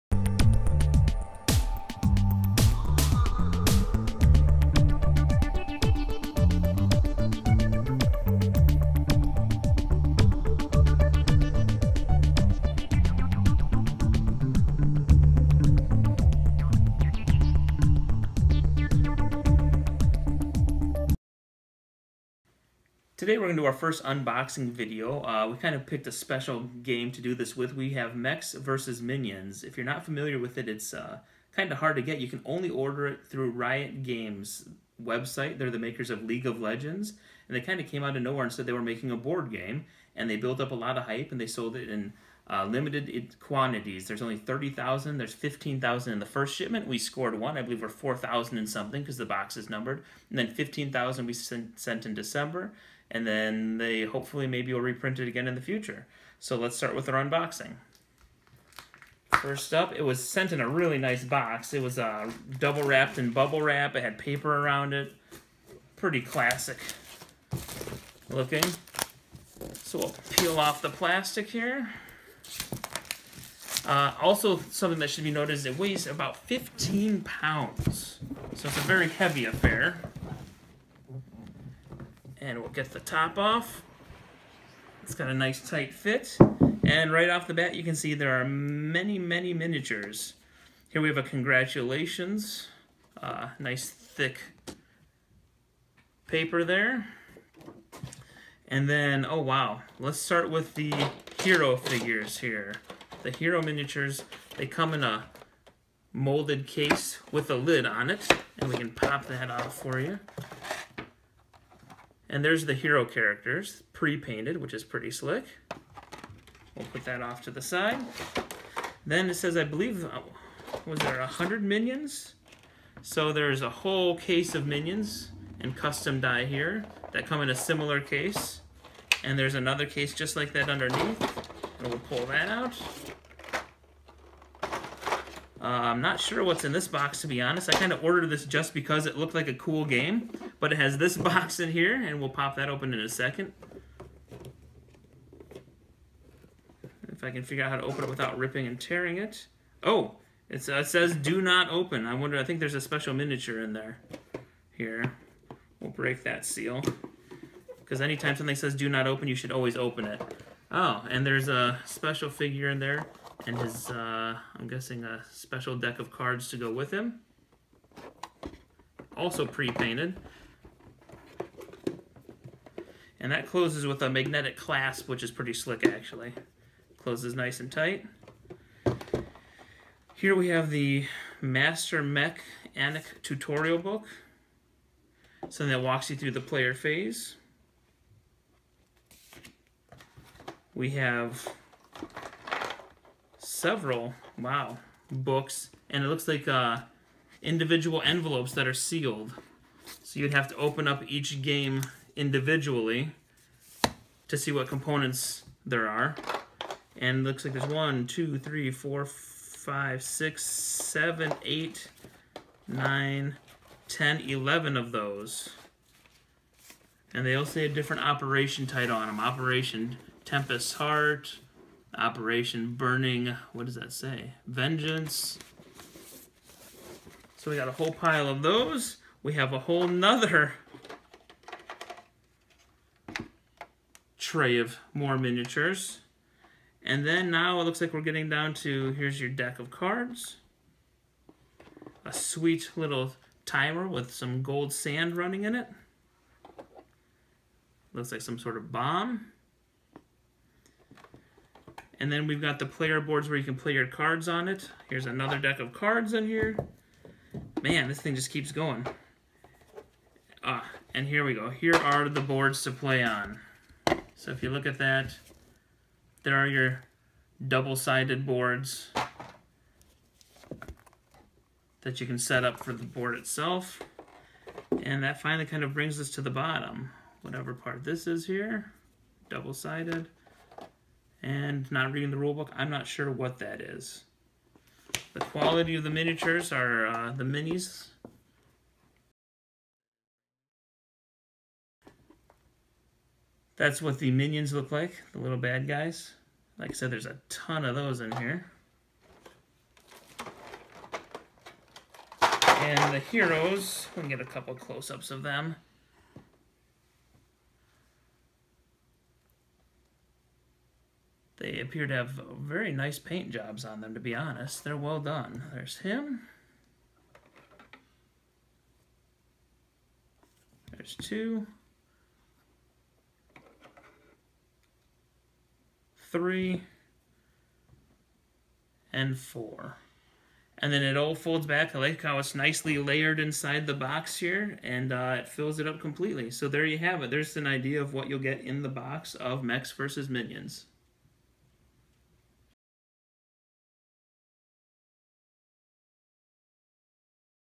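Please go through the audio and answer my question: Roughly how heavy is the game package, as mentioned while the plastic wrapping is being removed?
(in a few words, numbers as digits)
15 pounds.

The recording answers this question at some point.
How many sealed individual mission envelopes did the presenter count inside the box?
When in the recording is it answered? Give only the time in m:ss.
3:34.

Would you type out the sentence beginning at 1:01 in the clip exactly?
It was uh, double wrapped in bubble wrap.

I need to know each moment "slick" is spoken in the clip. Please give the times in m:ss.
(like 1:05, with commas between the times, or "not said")
1:55, 2:55.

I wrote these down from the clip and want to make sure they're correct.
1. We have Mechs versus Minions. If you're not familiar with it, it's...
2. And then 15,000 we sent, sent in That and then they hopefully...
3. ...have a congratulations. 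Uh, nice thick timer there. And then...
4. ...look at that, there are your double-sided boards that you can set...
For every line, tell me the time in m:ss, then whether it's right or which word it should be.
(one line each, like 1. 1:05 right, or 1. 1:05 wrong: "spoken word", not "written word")
1. 0:27 right
2. 0:50 wrong: "December", not "That"
3. 1:31 wrong: "paper", not "timer"
4. 4:24 right.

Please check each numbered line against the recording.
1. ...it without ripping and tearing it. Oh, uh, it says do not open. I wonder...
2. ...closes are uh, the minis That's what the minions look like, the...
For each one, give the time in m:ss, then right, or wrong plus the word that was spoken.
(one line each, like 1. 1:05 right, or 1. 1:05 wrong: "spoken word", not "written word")
1. 2:28 right
2. 4:45 wrong: "miniatures", not "closes".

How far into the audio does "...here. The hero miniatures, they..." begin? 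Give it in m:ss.
1:42.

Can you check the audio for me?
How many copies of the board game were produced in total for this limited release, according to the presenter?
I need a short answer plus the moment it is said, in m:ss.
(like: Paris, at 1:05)
30,000, at 0:44.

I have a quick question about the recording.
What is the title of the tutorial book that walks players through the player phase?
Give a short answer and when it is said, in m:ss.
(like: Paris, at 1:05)
Master Mech Anik, at 3:01.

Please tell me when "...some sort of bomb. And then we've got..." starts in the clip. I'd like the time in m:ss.
4:08.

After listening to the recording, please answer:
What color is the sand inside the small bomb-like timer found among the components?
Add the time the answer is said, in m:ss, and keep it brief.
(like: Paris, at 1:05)
Gold, at 4:04.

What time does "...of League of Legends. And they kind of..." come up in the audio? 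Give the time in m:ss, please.
0:36.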